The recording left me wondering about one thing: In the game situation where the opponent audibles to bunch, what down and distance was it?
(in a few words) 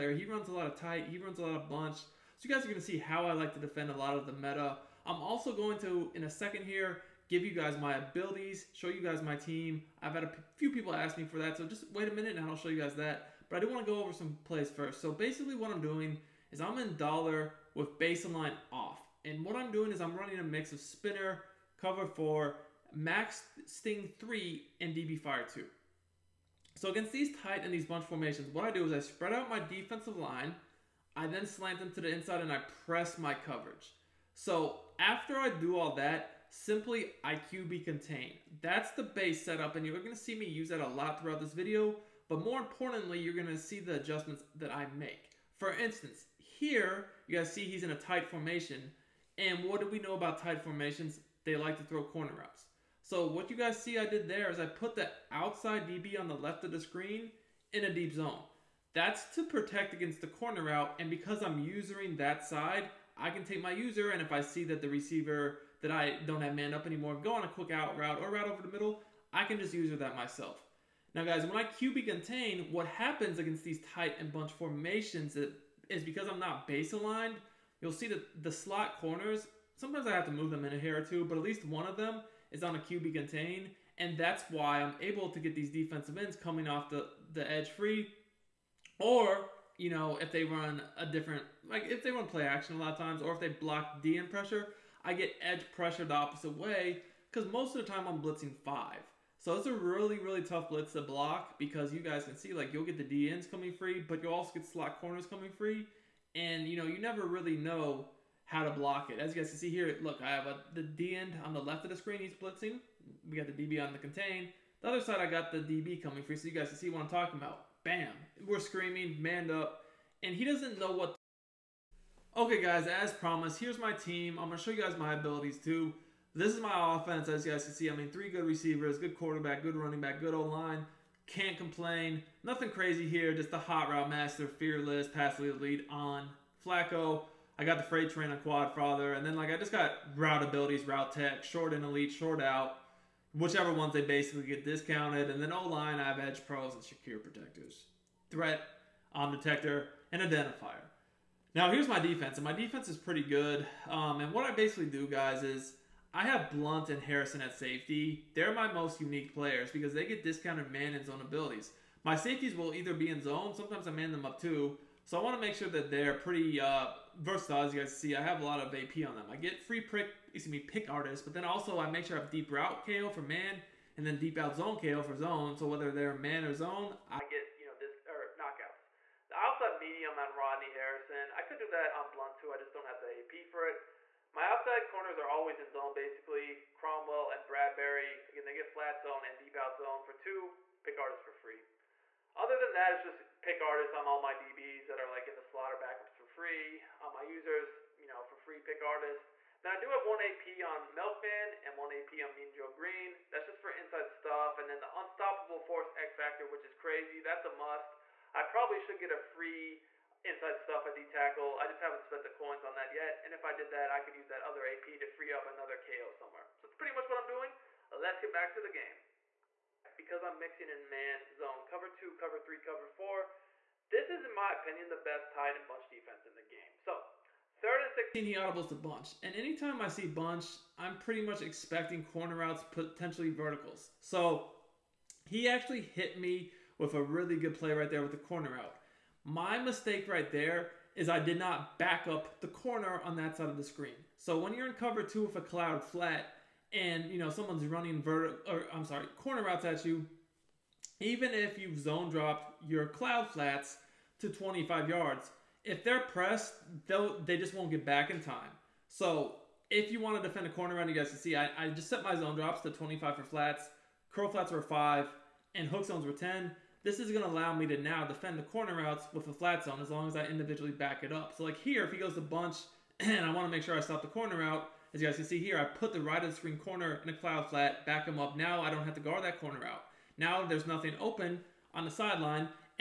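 Third and 16.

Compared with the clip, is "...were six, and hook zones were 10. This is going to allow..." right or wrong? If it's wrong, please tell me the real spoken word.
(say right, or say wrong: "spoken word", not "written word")
wrong: "five", not "six".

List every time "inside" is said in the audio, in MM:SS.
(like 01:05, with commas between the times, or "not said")
00:32, 03:23, 03:30.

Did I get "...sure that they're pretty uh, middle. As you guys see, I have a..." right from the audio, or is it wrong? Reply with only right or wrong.
wrong.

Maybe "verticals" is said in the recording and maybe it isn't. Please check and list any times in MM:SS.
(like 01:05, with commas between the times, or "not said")
03:53, 04:08.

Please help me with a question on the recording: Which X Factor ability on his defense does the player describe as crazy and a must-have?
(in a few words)
Unstoppable Force.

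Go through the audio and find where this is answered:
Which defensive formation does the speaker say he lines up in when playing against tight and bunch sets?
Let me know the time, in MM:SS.
00:16.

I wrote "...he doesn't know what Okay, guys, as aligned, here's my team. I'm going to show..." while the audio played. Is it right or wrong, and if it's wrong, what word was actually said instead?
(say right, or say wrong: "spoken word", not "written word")
wrong: "promised", not "aligned".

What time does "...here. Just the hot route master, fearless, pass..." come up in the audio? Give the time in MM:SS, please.
02:13.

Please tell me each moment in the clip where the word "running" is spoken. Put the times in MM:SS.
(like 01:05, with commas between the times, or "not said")
00:20, 02:09, 04:07.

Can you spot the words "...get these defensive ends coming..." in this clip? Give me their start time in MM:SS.
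01:25.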